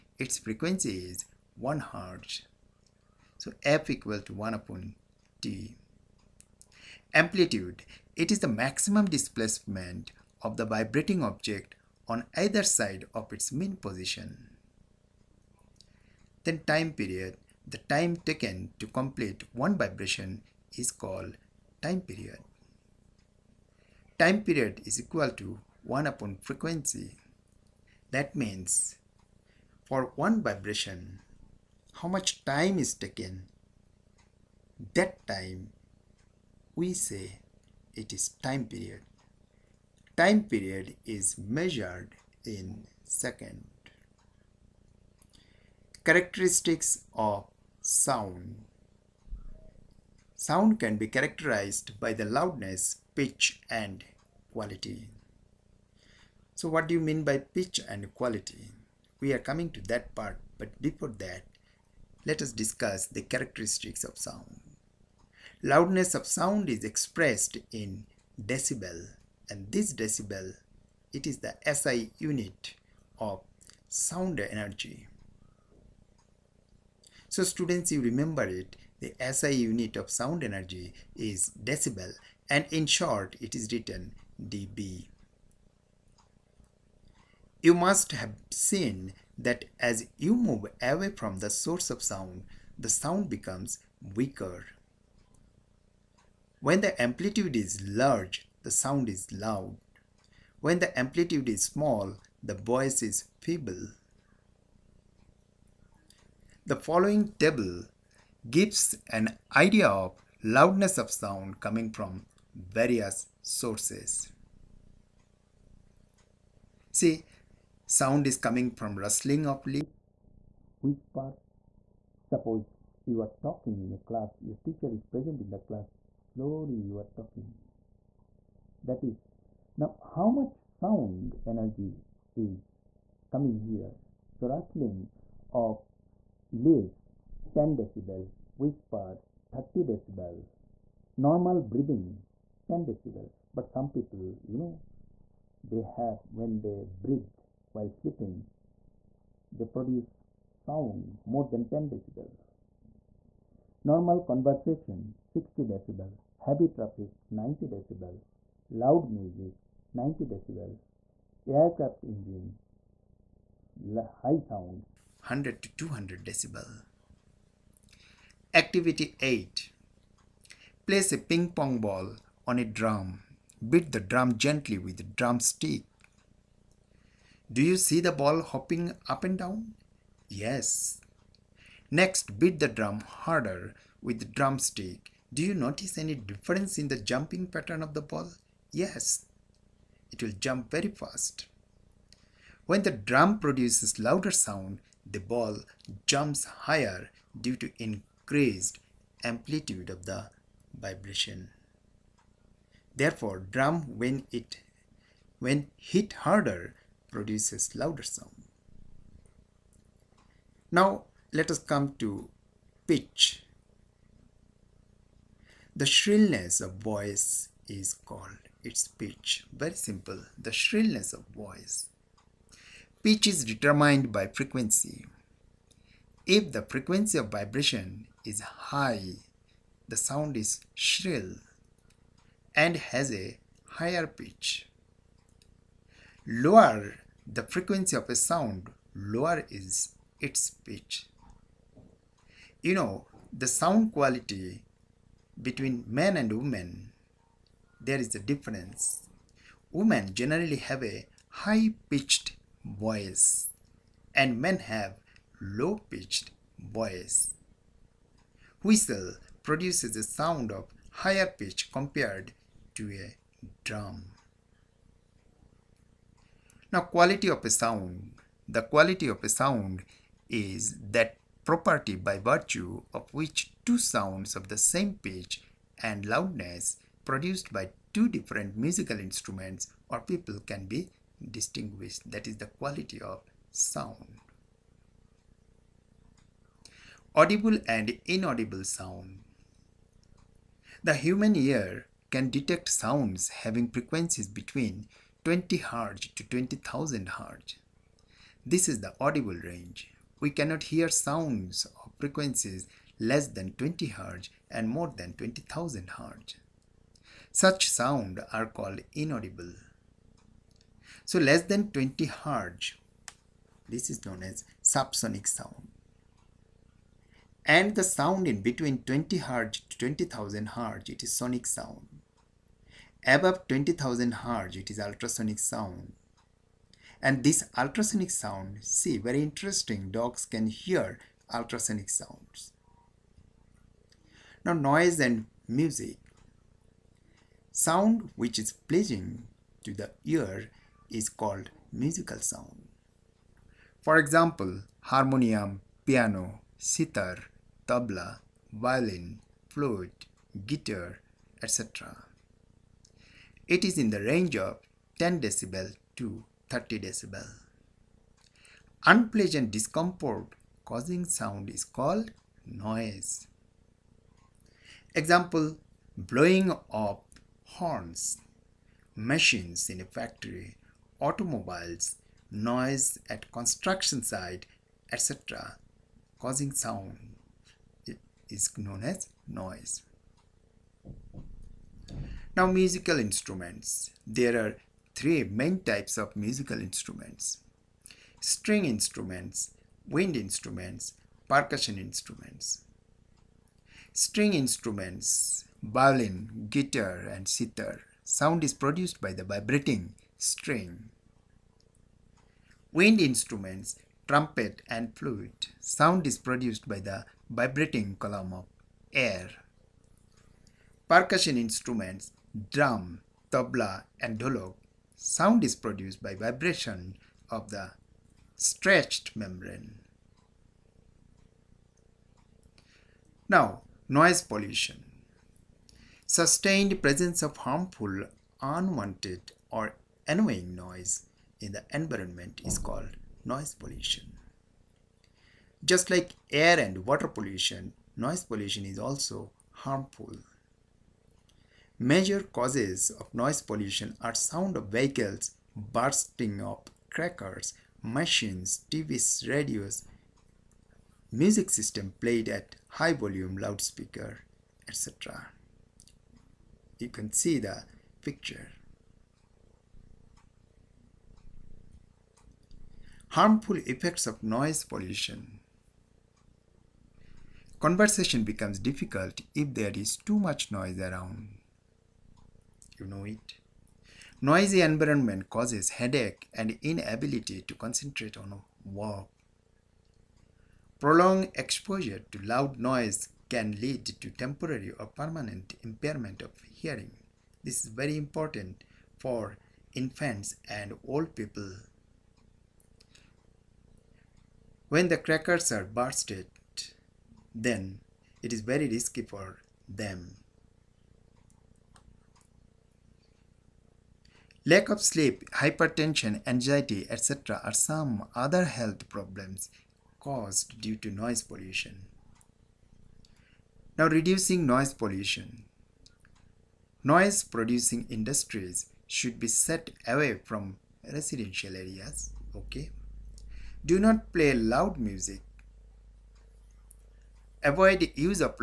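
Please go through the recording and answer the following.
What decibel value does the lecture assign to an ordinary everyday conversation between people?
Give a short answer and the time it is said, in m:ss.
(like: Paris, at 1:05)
60 decibel, at 2:33.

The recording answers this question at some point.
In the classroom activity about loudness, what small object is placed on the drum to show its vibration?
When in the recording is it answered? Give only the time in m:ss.
2:51.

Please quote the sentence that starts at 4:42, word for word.
That is the quality of sound audible and inaudible sound.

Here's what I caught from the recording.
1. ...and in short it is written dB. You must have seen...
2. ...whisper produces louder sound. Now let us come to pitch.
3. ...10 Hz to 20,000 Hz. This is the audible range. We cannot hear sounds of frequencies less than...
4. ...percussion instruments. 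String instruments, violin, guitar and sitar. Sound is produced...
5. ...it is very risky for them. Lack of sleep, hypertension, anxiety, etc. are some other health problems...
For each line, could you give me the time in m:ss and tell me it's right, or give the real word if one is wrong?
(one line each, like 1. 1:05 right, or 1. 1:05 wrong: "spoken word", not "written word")
1. 1:22 right
2. 3:26 wrong: "harder", not "whisper"
3. 4:55 wrong: "20", not "10"
4. 6:31 right
5. 8:18 right.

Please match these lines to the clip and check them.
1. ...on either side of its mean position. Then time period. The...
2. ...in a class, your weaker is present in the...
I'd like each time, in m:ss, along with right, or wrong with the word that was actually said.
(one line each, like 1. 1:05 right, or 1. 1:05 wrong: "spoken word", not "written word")
1. 0:12 right
2. 2:03 wrong: "teacher", not "weaker".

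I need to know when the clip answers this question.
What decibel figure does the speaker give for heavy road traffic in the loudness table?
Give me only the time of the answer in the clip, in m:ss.
2:36.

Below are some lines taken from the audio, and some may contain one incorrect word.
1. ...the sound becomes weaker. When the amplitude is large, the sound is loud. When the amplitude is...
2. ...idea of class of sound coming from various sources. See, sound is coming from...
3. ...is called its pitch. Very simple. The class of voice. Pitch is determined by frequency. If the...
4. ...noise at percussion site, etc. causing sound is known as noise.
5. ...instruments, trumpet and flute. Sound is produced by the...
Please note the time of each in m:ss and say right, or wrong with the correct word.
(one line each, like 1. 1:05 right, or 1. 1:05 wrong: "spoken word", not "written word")
1. 1:32 right
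2. 1:49 wrong: "loudness", not "class"
3. 3:37 wrong: "shrillness", not "class"
4. 6:12 wrong: "construction", not "percussion"
5. 6:43 right.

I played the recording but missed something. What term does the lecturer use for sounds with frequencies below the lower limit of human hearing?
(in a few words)
subsonic sound.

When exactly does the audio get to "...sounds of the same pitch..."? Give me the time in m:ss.
4:33.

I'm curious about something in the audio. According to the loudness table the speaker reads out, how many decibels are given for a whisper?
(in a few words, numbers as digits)
30 decibel.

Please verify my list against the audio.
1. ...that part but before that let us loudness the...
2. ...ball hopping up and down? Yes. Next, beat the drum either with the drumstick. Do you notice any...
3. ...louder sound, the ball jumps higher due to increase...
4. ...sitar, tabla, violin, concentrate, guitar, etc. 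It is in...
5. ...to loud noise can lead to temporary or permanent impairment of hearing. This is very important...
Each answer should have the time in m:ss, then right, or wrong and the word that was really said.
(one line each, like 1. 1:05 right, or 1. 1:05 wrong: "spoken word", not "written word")
1. 0:59 wrong: "discuss", not "loudness"
2. 2:58 wrong: "harder", not "either"
3. 3:13 right
4. 5:46 wrong: "flute", not "concentrate"
5. 8:02 right.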